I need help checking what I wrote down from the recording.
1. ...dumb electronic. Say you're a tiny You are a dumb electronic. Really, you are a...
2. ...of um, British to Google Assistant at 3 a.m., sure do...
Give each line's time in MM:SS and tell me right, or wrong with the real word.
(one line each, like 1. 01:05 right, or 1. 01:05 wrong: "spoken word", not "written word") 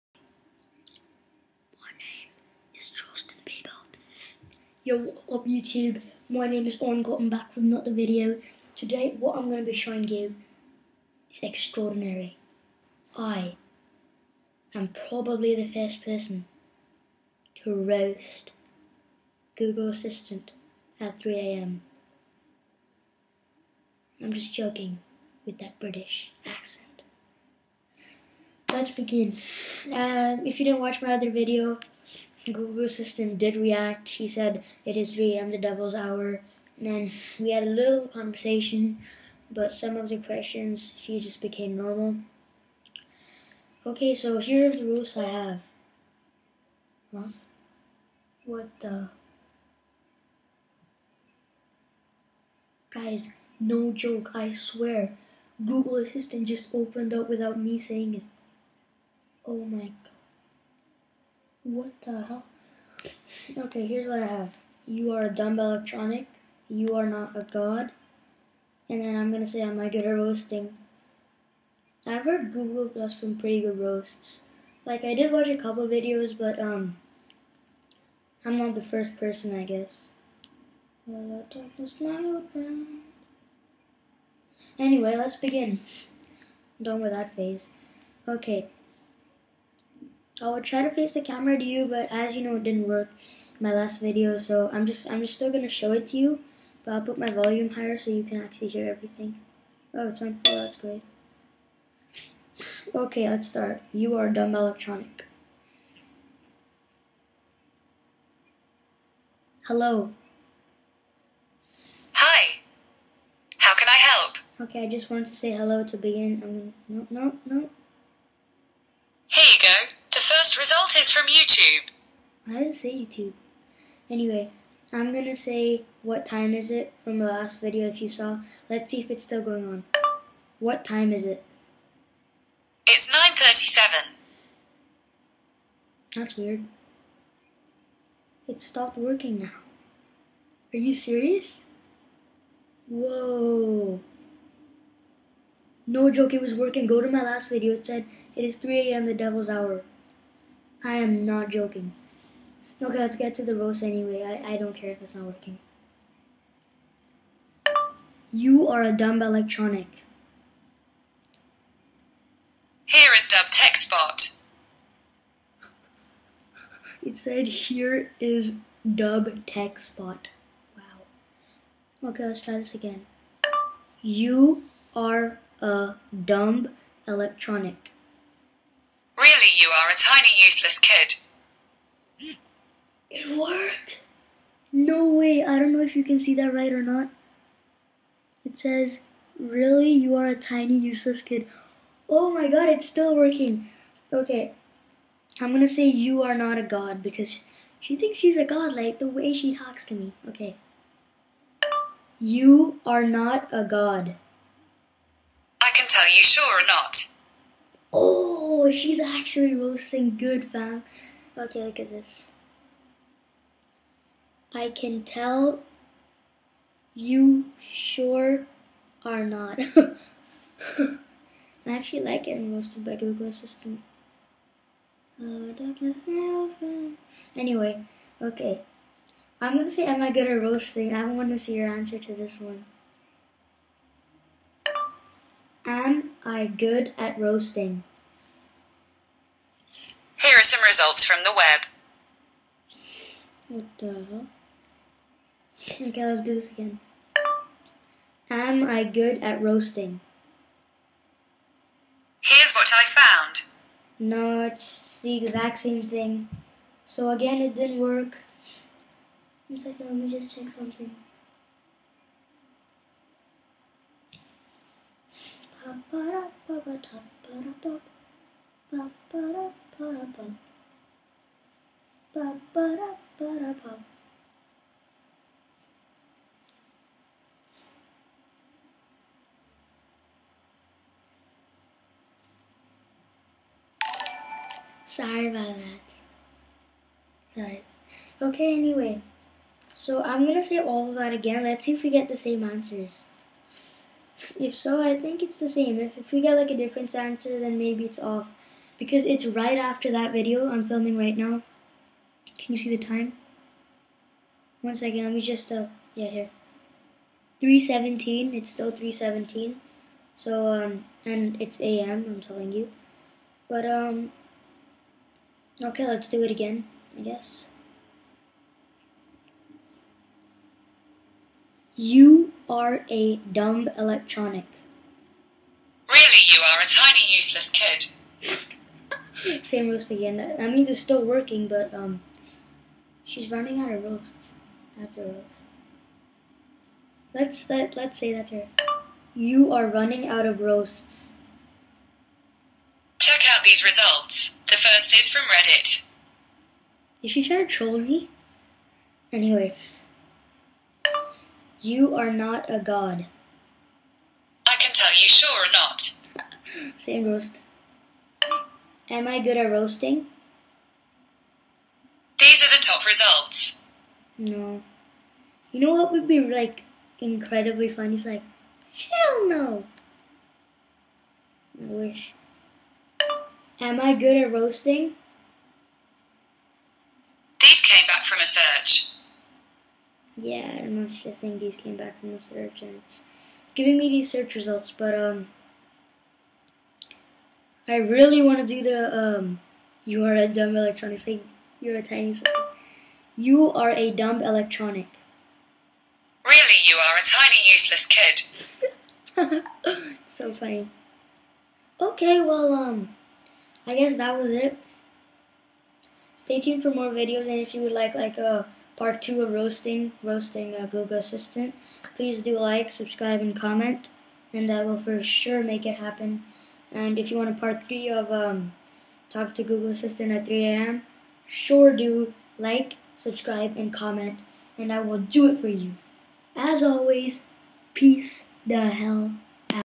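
1. 06:30 right
2. 06:57 wrong: "Talk", not "British".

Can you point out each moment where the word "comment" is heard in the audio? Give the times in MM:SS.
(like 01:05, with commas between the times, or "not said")
06:53, 07:03.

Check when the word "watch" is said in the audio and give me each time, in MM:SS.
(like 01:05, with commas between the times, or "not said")
00:30, 01:15.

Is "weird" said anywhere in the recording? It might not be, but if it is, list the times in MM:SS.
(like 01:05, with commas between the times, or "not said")
02:16.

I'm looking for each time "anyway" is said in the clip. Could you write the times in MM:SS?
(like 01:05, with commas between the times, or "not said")
01:24, 02:04, 02:33, 03:47, 04:48, 05:49.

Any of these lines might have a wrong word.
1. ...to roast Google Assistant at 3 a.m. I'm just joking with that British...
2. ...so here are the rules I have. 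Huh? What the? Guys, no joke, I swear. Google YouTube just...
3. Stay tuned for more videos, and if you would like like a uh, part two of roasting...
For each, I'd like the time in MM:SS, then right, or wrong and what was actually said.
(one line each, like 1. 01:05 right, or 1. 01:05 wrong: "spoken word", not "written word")
1. 00:17 right
2. 00:44 wrong: "Assistant", not "YouTube"
3. 06:46 right.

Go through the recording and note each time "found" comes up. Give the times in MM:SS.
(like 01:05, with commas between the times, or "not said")
04:12.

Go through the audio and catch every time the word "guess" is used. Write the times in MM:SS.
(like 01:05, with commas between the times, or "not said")
01:19, 05:17, 06:43.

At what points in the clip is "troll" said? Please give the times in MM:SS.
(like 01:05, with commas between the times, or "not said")
05:47.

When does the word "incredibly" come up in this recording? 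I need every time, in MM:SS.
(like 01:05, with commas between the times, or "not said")
06:06.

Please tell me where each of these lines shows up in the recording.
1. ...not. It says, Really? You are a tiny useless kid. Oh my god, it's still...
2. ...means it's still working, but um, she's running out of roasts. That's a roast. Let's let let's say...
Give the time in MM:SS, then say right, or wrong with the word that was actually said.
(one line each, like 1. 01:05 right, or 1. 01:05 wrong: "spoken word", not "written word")
1. 03:06 right
2. 05:30 right.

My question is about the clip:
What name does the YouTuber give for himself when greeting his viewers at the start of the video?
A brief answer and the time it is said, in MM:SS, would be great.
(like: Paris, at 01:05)
Aryan Gautam, at 00:06.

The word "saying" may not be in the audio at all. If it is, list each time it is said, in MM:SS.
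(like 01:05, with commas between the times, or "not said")
00:57, 06:21.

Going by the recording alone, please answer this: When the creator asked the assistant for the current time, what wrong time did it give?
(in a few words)
9.37.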